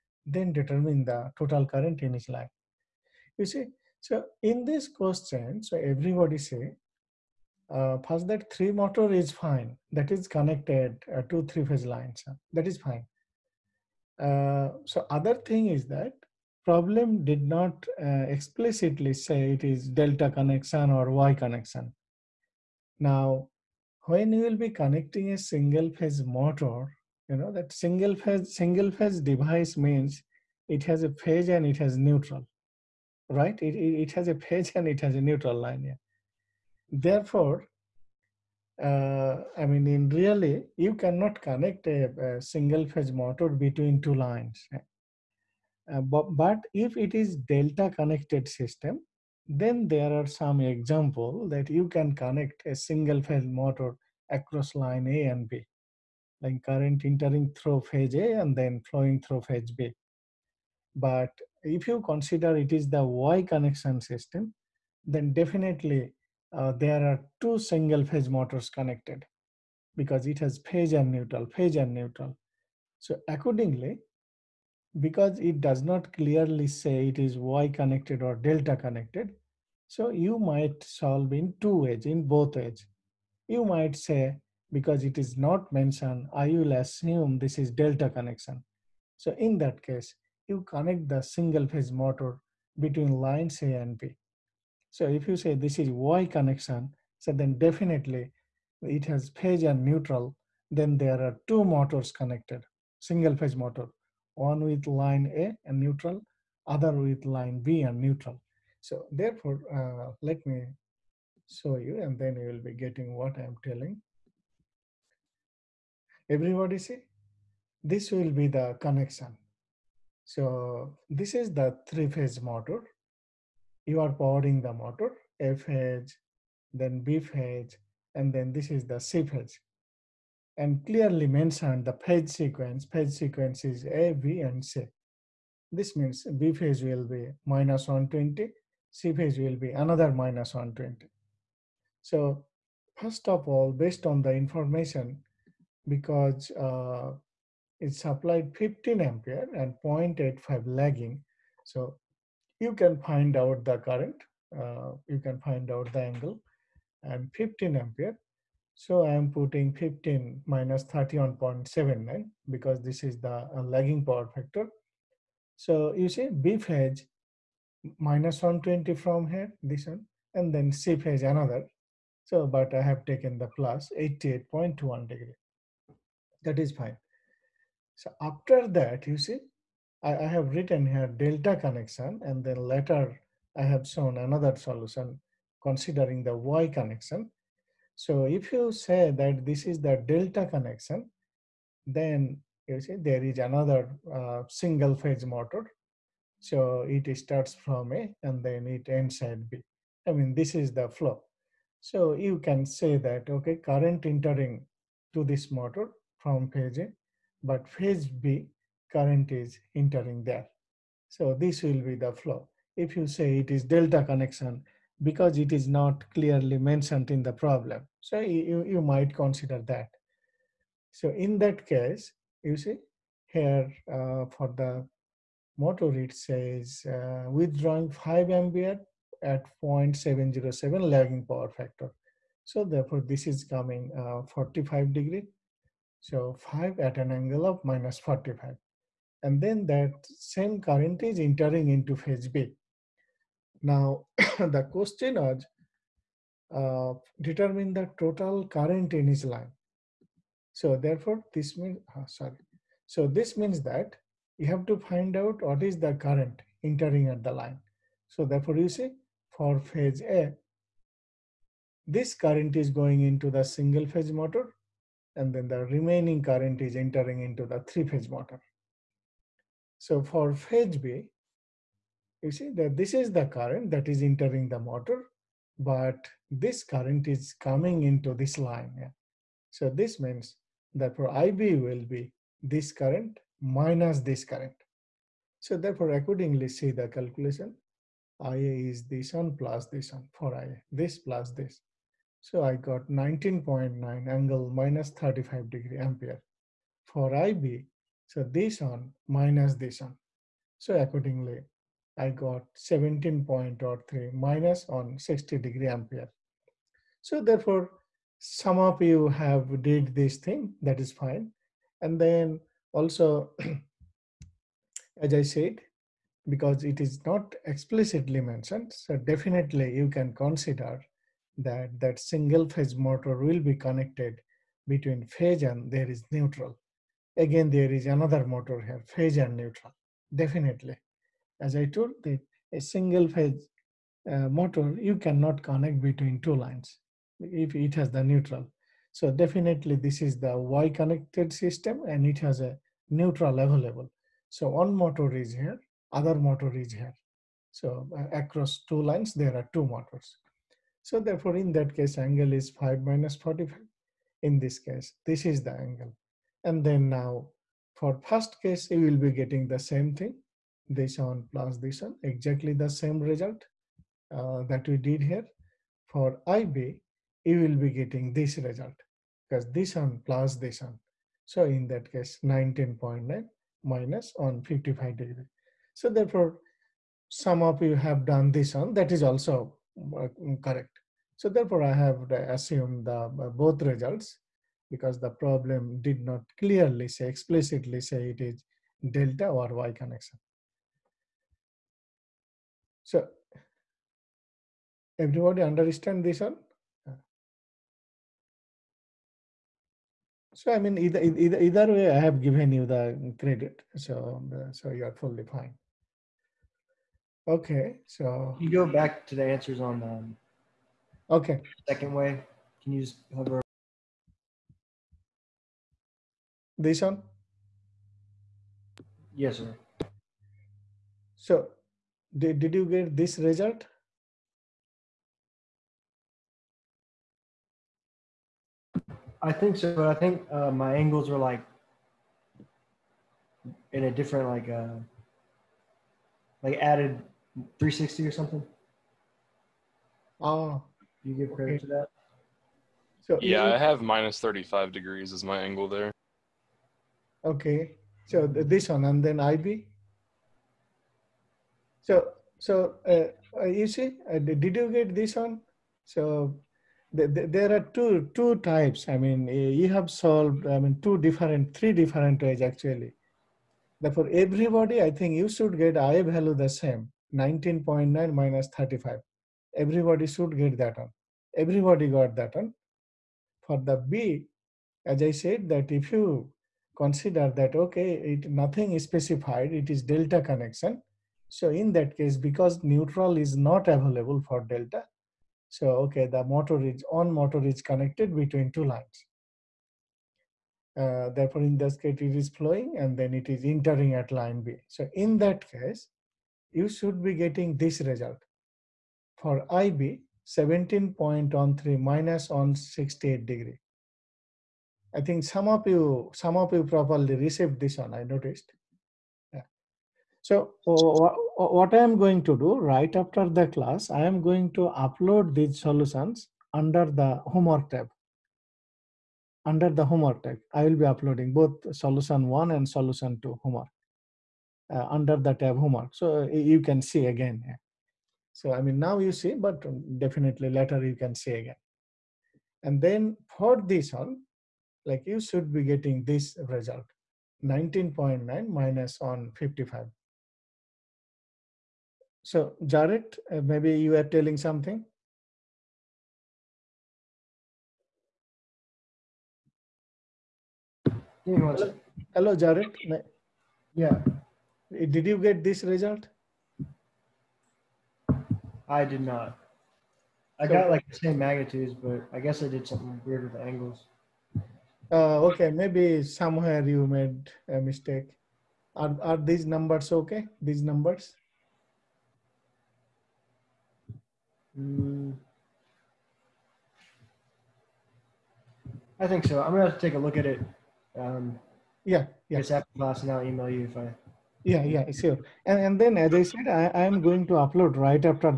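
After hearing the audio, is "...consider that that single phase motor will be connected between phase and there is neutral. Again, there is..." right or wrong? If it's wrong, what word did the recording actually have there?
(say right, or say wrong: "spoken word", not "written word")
right.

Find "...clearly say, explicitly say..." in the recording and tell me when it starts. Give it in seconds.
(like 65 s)
386 s.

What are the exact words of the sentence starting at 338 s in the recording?
So definitely this is the Y connected system and it has a neutral available.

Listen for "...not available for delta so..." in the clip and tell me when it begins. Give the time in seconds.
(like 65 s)
483 s.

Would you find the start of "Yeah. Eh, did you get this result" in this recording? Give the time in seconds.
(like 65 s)
553 s.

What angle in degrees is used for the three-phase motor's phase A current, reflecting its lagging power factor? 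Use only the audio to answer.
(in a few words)
-31.79.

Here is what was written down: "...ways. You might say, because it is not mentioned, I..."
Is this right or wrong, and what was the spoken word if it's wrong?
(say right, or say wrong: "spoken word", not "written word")
right.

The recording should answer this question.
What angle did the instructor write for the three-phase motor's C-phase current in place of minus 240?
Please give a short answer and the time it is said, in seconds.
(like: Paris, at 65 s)
88.1 degrees, at 173 s.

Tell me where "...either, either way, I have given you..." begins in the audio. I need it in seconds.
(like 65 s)
401 s.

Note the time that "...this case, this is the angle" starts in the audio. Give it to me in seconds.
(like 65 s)
354 s.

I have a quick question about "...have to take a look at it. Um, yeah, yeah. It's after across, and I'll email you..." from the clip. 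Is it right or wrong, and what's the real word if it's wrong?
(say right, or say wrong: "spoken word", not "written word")
wrong: "class", not "across".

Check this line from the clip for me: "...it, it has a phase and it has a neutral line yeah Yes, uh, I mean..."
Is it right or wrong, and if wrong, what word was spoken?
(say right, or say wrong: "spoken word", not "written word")
wrong: "Therefore", not "Yes".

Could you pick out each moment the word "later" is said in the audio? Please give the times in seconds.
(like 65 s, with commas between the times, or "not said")
182 s, 530 s.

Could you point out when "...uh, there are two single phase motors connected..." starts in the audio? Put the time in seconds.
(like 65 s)
66 s.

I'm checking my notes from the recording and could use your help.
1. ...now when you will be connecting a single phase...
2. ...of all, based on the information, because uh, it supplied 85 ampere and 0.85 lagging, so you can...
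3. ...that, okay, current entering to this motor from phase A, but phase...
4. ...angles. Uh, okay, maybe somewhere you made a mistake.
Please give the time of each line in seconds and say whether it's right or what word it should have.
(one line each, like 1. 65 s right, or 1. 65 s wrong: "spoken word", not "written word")
1. 22 s right
2. 143 s wrong: "15", not "85"
3. 202 s right
4. 563 s right.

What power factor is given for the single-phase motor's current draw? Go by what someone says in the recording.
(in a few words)
0.707 lagging.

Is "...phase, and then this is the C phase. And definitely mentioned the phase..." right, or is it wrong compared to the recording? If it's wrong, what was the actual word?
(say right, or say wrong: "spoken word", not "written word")
wrong: "clearly", not "definitely".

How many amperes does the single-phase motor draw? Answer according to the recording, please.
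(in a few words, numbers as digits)
5.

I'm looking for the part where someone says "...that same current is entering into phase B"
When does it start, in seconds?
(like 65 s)
239 s.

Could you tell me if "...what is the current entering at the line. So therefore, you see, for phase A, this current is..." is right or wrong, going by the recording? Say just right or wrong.
right.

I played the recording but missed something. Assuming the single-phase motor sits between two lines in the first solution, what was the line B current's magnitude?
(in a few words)
17.03.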